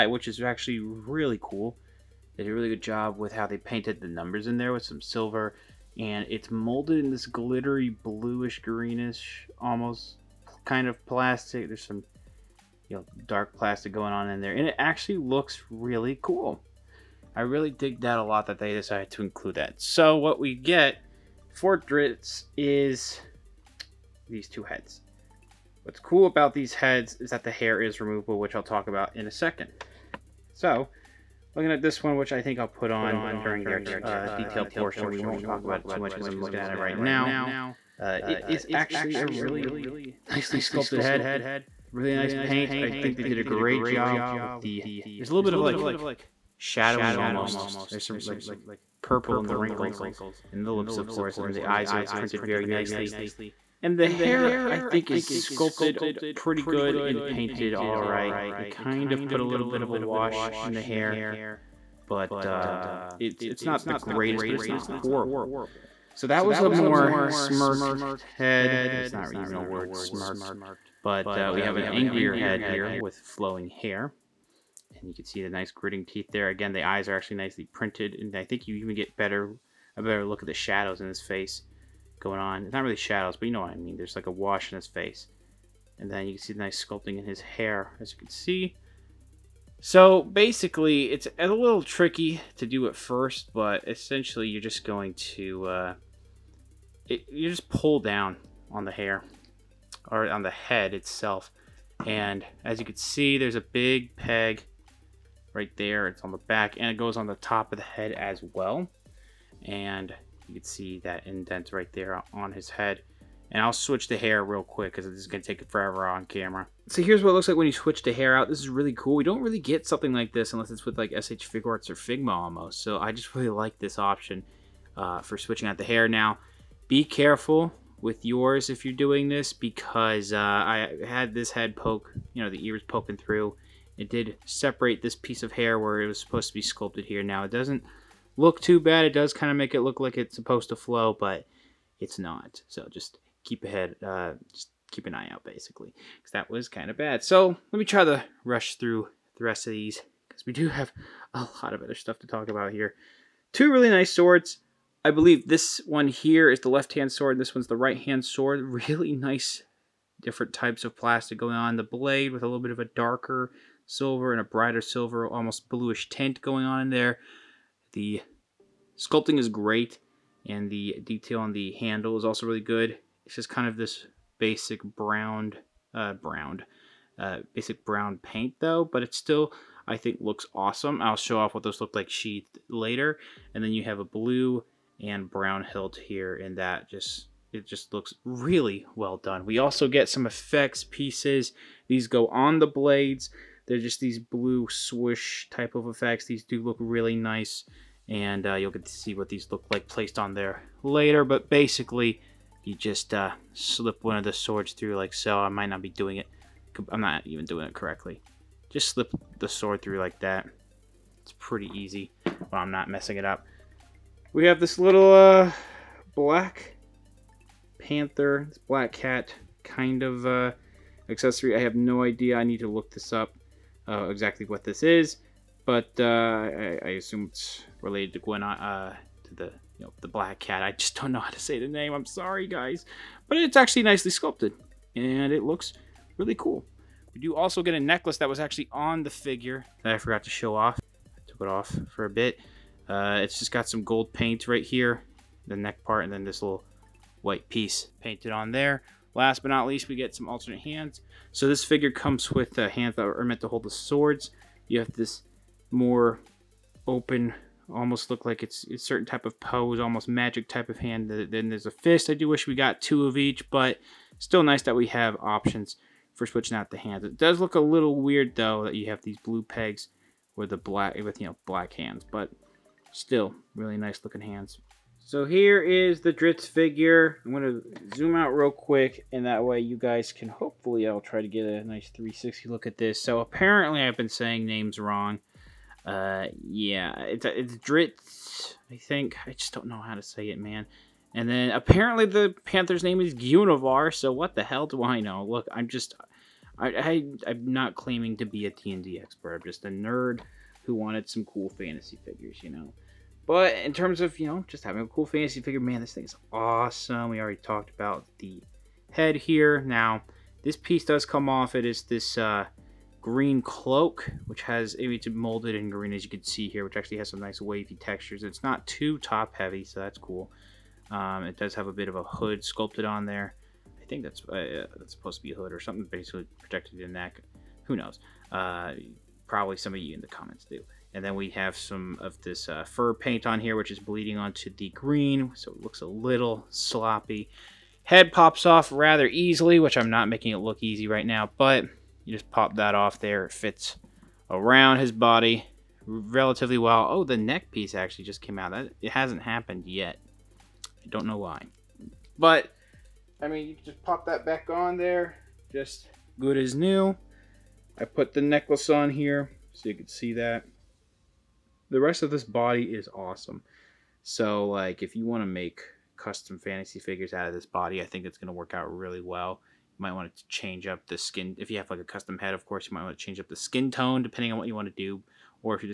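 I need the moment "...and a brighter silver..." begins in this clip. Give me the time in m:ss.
2:44.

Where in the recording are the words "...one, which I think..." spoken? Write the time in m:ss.
0:32.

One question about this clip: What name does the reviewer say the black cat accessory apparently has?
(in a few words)
Gunivar.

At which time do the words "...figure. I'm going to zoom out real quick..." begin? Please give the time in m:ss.
4:36.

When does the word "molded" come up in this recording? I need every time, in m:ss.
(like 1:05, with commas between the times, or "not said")
0:06, 5:15.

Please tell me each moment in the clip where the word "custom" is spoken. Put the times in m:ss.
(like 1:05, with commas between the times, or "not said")
6:05, 6:11.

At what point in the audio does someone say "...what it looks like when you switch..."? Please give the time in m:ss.
1:57.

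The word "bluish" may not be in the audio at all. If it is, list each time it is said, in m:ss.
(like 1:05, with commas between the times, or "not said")
0:07, 2:45.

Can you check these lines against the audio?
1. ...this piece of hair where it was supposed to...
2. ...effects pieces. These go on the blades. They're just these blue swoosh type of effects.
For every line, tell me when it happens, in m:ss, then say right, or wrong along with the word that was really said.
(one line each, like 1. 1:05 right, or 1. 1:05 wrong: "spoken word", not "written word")
1. 2:15 right
2. 3:10 right.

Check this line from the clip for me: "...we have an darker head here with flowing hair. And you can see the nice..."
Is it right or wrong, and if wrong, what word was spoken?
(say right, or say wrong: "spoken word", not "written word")
wrong: "angrier", not "darker".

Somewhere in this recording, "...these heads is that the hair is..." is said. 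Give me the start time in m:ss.
0:26.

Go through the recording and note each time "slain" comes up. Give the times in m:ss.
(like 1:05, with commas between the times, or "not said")
not said.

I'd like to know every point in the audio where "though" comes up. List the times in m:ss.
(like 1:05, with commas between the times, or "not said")
2:58, 4:28.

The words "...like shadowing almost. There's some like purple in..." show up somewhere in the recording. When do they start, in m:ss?
0:45.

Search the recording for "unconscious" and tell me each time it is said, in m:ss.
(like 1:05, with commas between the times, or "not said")
not said.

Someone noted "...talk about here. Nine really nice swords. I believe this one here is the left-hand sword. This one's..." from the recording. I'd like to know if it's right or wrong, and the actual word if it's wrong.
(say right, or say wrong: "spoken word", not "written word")
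wrong: "Two", not "Nine".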